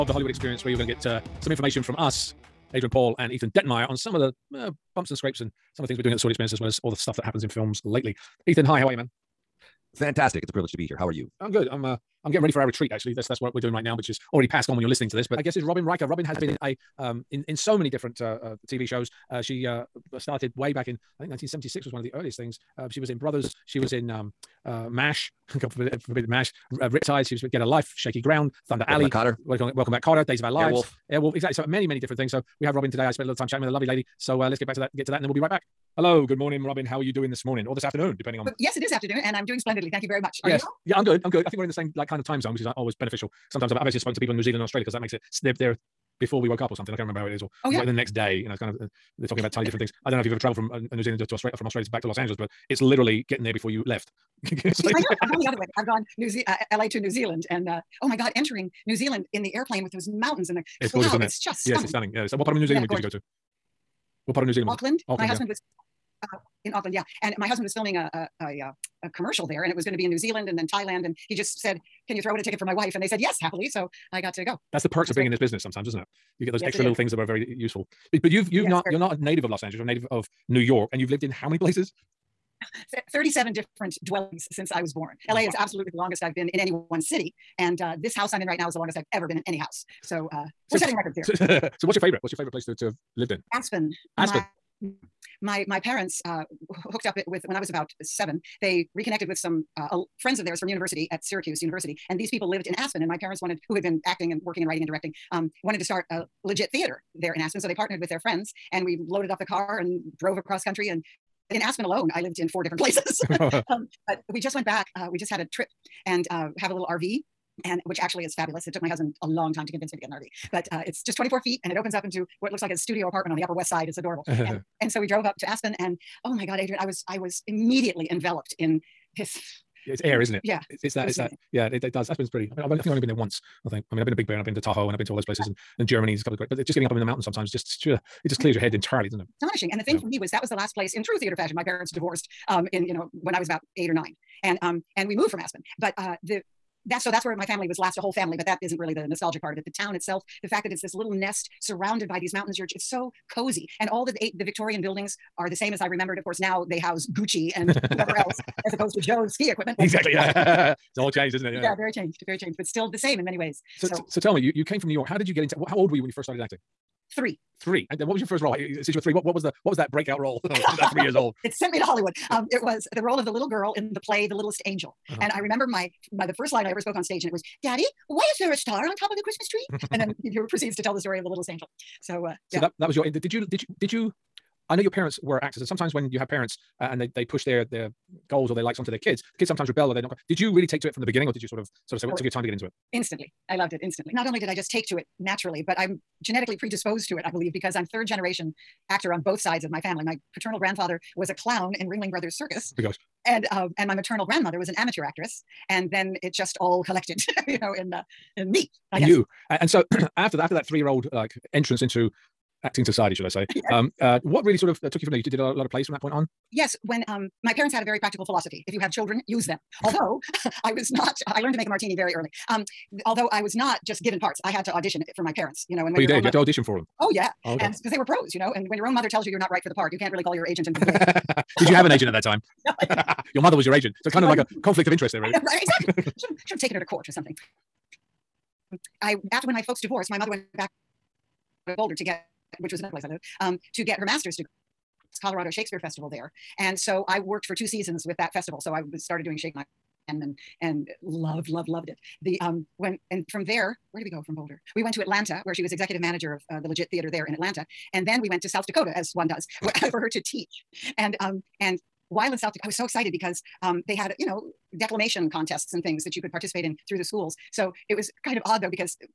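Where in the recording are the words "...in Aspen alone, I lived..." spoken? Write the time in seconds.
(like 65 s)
111 s.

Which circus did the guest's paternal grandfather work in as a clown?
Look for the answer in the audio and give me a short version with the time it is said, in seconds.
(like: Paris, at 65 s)
Ringling Brothers Circus, at 201 s.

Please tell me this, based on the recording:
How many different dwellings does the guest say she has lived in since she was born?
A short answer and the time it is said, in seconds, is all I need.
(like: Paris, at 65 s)
37, at 83 s.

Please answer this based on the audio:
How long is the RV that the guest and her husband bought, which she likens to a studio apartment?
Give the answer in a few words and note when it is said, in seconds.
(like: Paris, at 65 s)
24 feet, at 121 s.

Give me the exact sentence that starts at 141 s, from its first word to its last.
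My parents divorced um, in, you know, when I was about eight or nine.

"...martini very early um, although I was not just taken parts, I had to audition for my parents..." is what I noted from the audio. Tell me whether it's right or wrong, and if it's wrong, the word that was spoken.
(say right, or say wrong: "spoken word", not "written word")
wrong: "given", not "taken".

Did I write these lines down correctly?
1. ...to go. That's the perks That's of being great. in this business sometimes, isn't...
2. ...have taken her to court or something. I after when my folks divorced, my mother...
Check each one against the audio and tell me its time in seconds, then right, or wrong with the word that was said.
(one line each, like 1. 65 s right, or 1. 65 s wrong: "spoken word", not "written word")
1. 74 s right
2. 236 s right.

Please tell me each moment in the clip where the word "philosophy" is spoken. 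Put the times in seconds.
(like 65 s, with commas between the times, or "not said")
218 s.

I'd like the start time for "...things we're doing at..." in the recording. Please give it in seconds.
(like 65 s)
5 s.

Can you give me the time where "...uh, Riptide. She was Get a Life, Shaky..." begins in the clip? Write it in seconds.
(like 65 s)
26 s.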